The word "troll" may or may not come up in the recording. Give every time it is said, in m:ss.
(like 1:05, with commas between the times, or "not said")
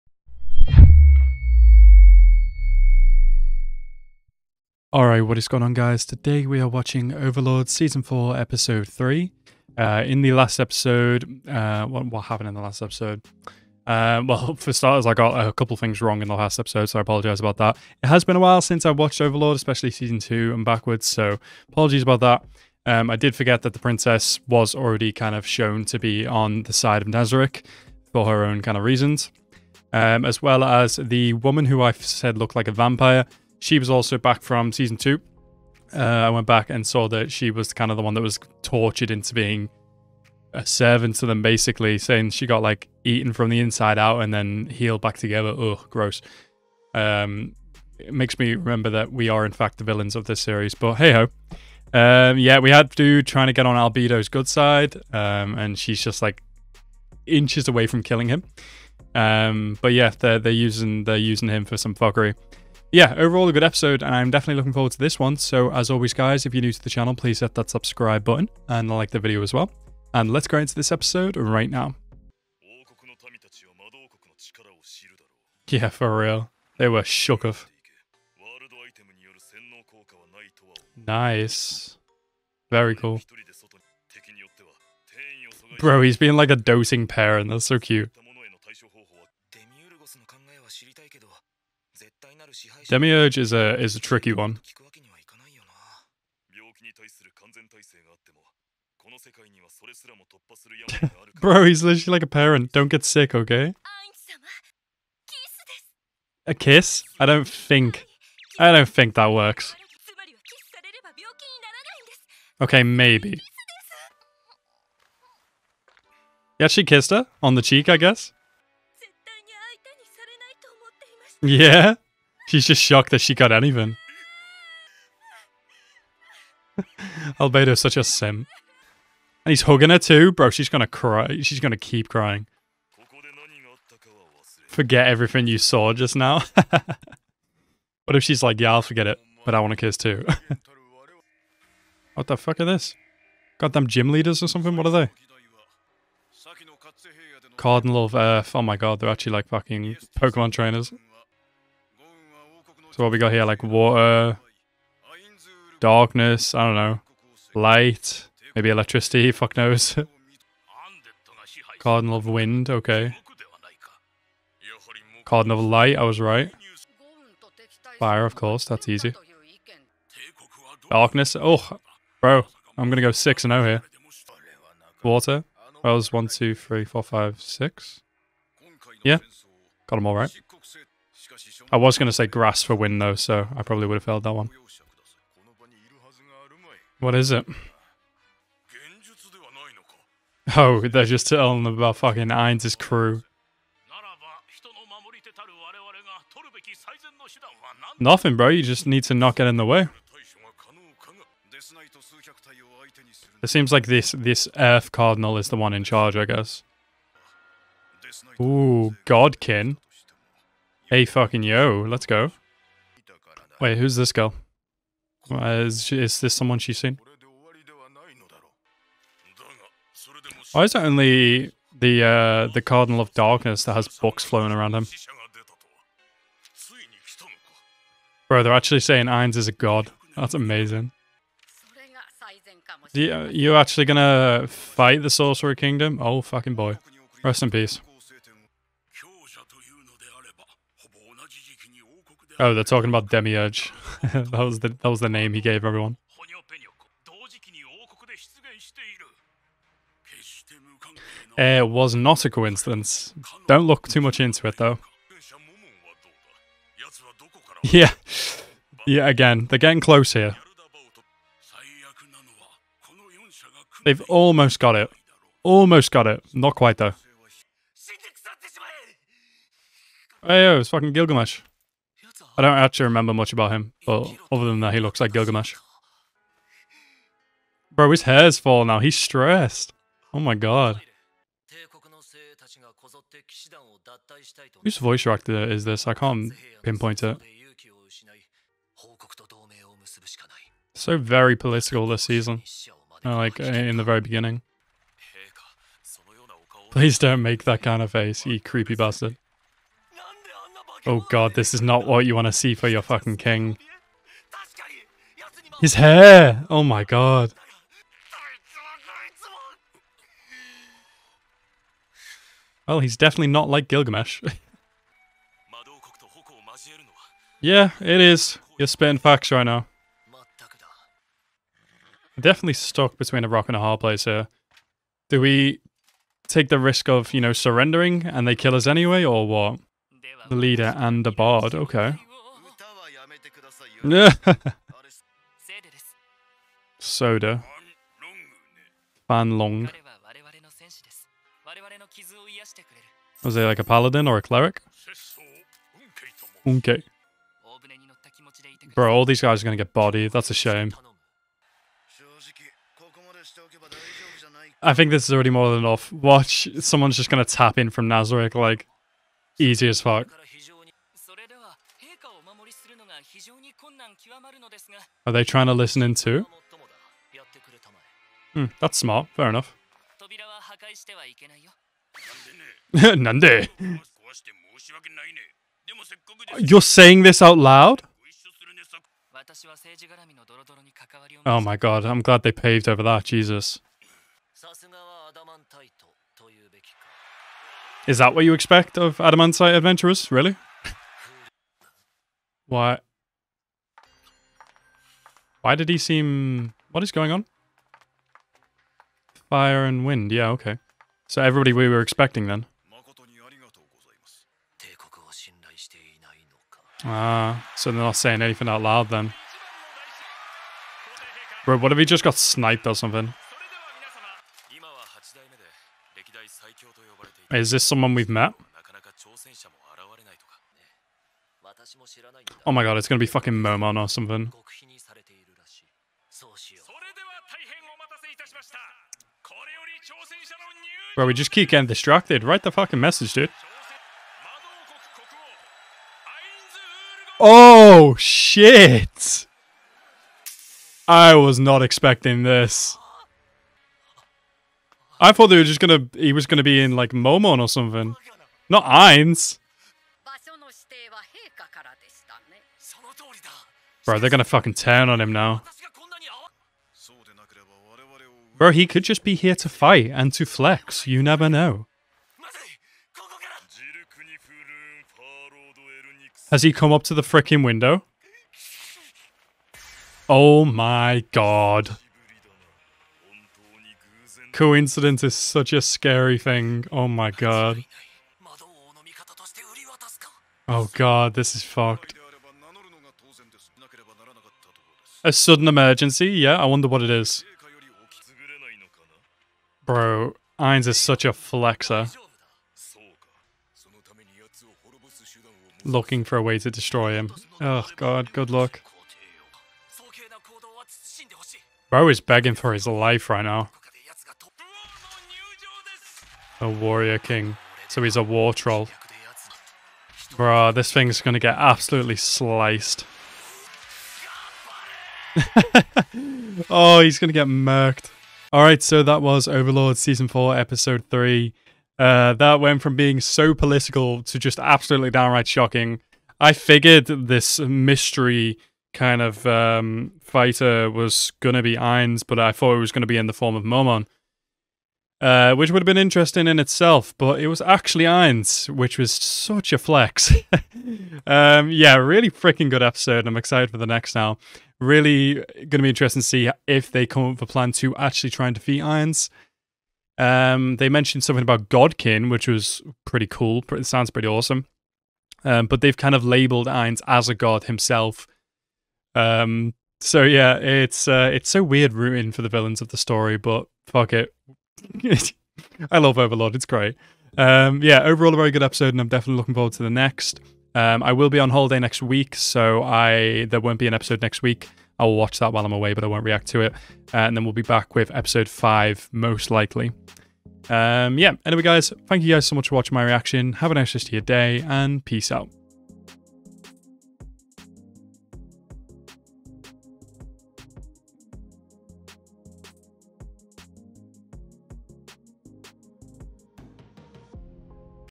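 8:28.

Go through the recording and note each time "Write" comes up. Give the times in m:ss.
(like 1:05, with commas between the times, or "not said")
7:12.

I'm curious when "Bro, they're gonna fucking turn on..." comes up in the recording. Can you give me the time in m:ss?
7:33.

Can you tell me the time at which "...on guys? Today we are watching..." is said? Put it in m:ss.
0:05.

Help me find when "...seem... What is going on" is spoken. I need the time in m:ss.
6:35.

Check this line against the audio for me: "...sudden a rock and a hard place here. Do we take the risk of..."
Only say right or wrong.
wrong.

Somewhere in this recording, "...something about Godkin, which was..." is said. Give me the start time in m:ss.
9:11.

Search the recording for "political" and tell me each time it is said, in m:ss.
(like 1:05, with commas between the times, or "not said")
4:51, 8:43.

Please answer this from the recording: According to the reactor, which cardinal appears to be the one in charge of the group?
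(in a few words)
Earth Cardinal.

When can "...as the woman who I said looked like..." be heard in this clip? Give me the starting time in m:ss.
0:30.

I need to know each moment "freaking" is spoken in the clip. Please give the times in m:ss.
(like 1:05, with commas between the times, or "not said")
7:47, 9:02.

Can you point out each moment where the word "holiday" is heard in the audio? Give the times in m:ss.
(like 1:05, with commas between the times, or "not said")
9:31.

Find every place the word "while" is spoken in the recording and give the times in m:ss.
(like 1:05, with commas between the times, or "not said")
0:18, 9:35.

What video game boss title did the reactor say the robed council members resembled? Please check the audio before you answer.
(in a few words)
Gym leaders.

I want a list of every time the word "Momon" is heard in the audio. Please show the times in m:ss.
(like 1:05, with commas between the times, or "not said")
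7:03, 7:26, 8:53.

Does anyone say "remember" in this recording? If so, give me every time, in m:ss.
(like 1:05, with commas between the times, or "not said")
0:48, 4:32.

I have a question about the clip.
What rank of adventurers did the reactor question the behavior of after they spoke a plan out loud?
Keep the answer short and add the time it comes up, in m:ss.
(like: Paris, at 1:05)
Adamantite, at 6:28.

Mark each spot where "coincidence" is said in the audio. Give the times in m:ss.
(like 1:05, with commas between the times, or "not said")
4:12, 7:54.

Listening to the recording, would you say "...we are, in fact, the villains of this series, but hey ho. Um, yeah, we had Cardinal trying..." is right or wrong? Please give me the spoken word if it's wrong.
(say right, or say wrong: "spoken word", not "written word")
wrong: "Dude", not "Cardinal".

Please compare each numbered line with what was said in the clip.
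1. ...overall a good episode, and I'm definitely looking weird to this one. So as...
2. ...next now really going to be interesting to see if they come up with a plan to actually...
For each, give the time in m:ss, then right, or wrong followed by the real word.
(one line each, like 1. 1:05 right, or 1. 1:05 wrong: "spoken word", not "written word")
1. 1:03 wrong: "forward", not "weird"
2. 9:03 right.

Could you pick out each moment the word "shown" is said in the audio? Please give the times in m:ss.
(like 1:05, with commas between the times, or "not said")
0:25.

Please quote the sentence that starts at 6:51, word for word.
Bro, what if he just got sniped or something?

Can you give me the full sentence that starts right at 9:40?
Um, yeah, anyway, guys, thank you guys so much for watching my reaction.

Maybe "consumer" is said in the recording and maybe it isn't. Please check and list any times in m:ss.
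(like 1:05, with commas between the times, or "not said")
not said.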